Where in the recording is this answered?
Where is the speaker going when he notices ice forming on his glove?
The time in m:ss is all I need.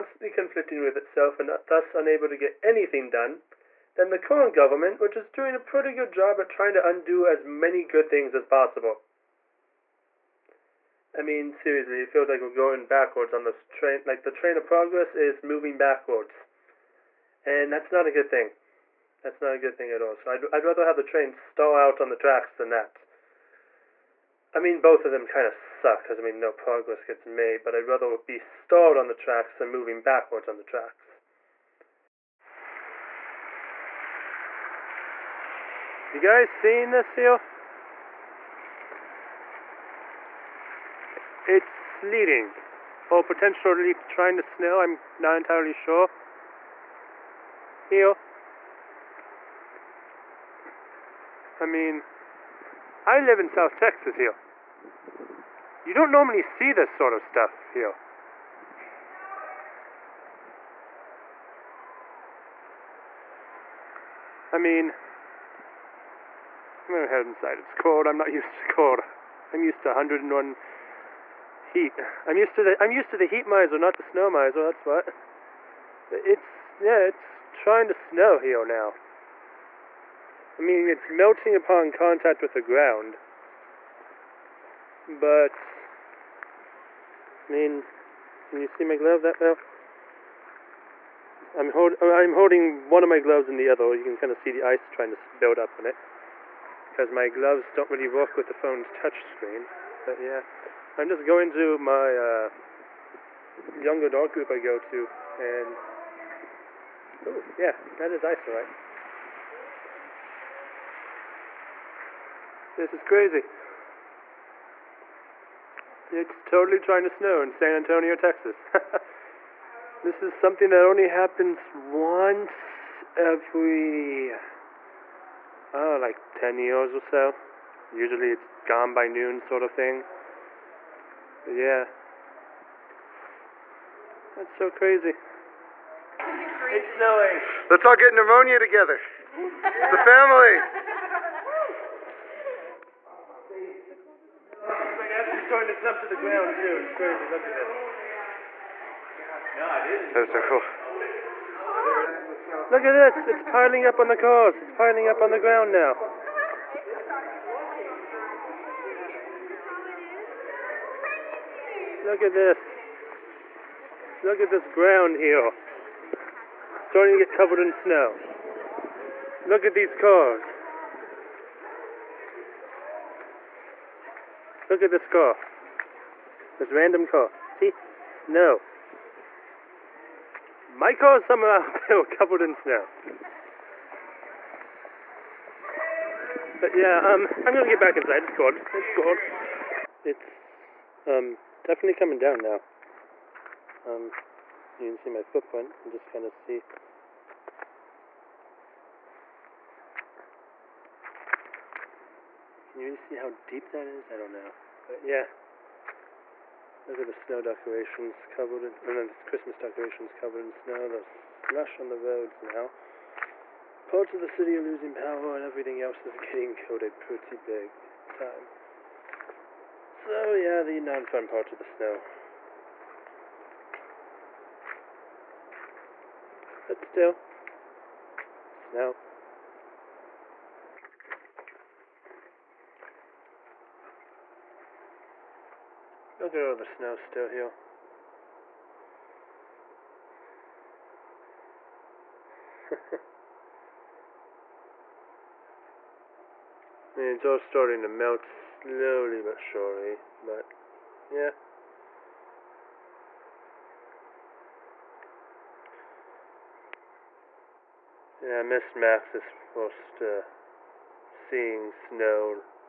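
1:43.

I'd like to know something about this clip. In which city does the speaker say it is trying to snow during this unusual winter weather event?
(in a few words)
San Antonio, Texas.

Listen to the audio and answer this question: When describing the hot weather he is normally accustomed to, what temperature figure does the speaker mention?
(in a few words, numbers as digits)
101.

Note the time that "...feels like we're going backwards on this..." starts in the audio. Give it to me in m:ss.
0:12.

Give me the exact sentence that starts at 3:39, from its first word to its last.
So yeah, the non-fun part of the snow.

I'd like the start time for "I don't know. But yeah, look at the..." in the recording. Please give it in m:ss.
3:24.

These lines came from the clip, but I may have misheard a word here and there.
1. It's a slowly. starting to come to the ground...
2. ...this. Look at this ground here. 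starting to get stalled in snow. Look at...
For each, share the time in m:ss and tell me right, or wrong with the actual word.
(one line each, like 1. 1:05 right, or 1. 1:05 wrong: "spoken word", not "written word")
1. 2:19 wrong: "family", not "slowly"
2. 2:42 wrong: "covered", not "stalled".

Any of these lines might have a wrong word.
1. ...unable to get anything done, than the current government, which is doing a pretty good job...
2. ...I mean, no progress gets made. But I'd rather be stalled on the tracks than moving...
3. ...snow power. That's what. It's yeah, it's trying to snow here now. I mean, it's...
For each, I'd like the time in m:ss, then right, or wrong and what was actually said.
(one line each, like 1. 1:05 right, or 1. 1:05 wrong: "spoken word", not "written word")
1. 0:01 right
2. 0:26 right
3. 1:14 wrong: "miser", not "power".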